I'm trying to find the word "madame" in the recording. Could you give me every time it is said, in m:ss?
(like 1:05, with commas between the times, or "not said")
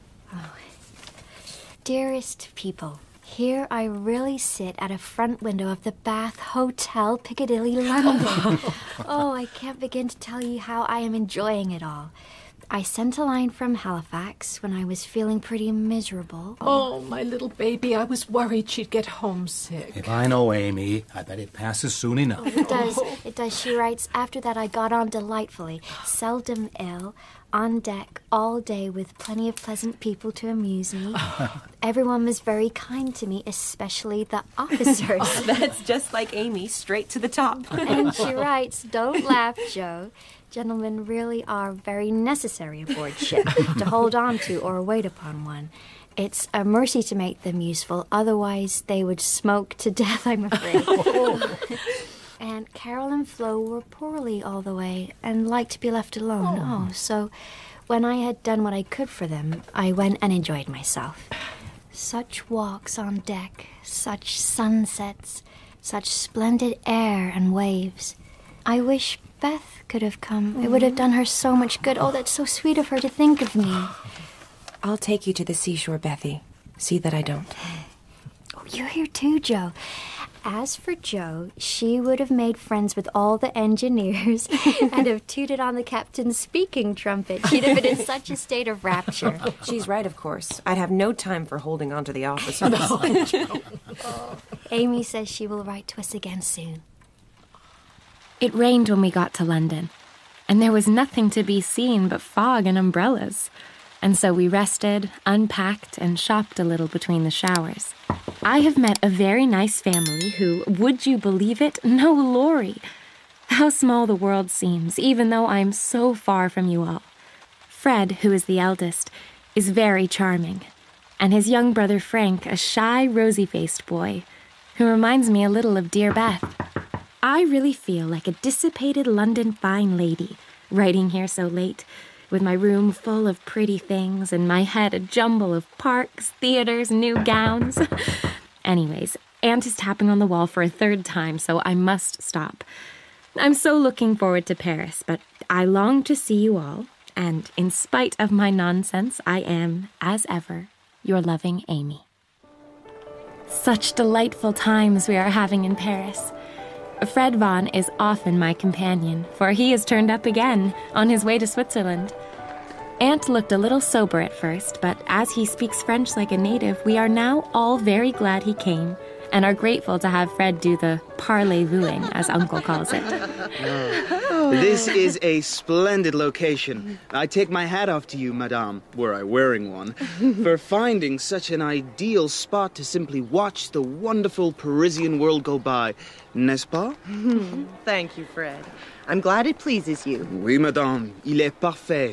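2:58, 3:10.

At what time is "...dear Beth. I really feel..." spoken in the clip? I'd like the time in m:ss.
2:05.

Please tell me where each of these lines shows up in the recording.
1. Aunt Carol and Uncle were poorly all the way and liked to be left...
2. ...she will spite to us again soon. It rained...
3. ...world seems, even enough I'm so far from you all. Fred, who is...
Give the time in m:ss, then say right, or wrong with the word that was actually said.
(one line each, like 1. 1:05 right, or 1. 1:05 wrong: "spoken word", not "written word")
1. 0:52 wrong: "Flo", not "Uncle"
2. 1:35 wrong: "write", not "spite"
3. 1:54 wrong: "though", not "enough".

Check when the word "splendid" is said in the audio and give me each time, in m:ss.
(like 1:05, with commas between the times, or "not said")
1:06, 2:55.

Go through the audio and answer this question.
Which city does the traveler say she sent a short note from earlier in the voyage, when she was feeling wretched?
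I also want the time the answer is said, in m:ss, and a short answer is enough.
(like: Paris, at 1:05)
Halifax, at 0:13.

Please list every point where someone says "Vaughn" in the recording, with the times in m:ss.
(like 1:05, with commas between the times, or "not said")
2:37.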